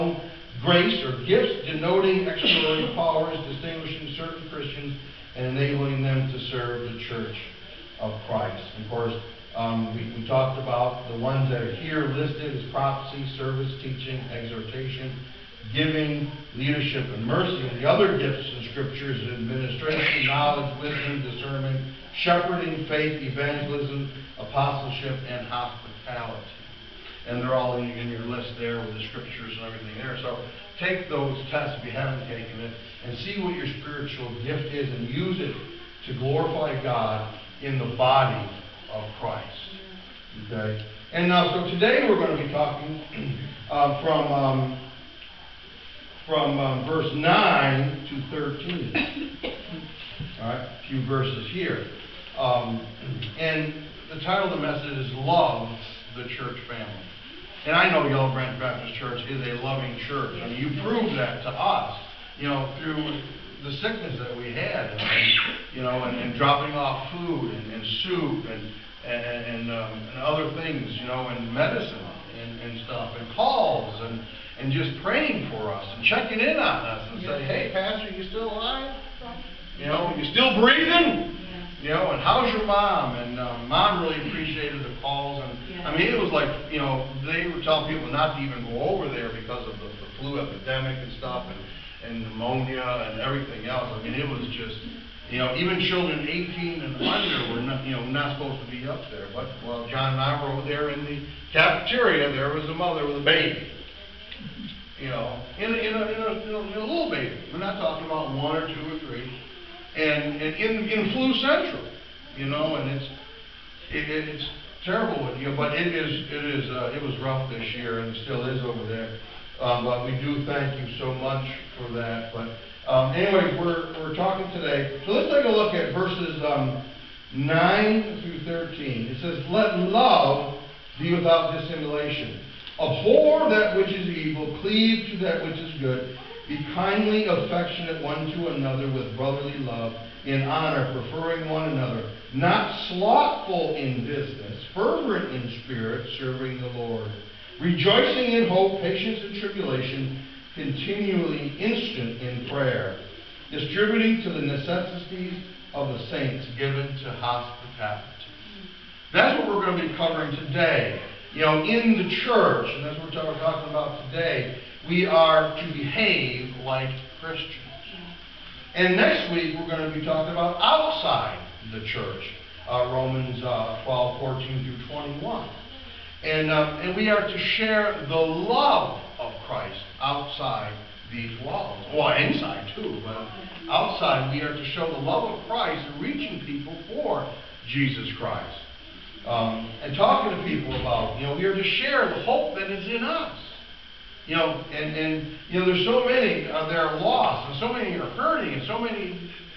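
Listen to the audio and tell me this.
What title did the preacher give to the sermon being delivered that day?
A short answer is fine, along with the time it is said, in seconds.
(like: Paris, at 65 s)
Love the Church Family, at 55 s.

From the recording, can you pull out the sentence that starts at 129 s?
It says, Let love be without dissimulation.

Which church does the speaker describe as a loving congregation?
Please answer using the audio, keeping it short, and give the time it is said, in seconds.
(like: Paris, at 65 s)
Yellow Branch Baptist Church, at 58 s.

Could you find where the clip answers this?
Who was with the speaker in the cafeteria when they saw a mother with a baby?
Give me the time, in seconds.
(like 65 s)
99 s.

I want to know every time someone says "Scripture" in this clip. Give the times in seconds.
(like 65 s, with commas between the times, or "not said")
18 s, 29 s.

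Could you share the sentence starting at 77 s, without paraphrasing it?
say, hey, Pastor, you still alive?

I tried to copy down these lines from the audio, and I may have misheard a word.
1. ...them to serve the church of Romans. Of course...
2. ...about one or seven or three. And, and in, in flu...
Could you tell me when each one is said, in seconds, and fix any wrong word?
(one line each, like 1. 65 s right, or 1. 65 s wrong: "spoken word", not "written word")
1. 6 s wrong: "Christ", not "Romans"
2. 108 s wrong: "two", not "seven".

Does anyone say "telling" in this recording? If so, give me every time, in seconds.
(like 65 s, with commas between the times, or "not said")
87 s.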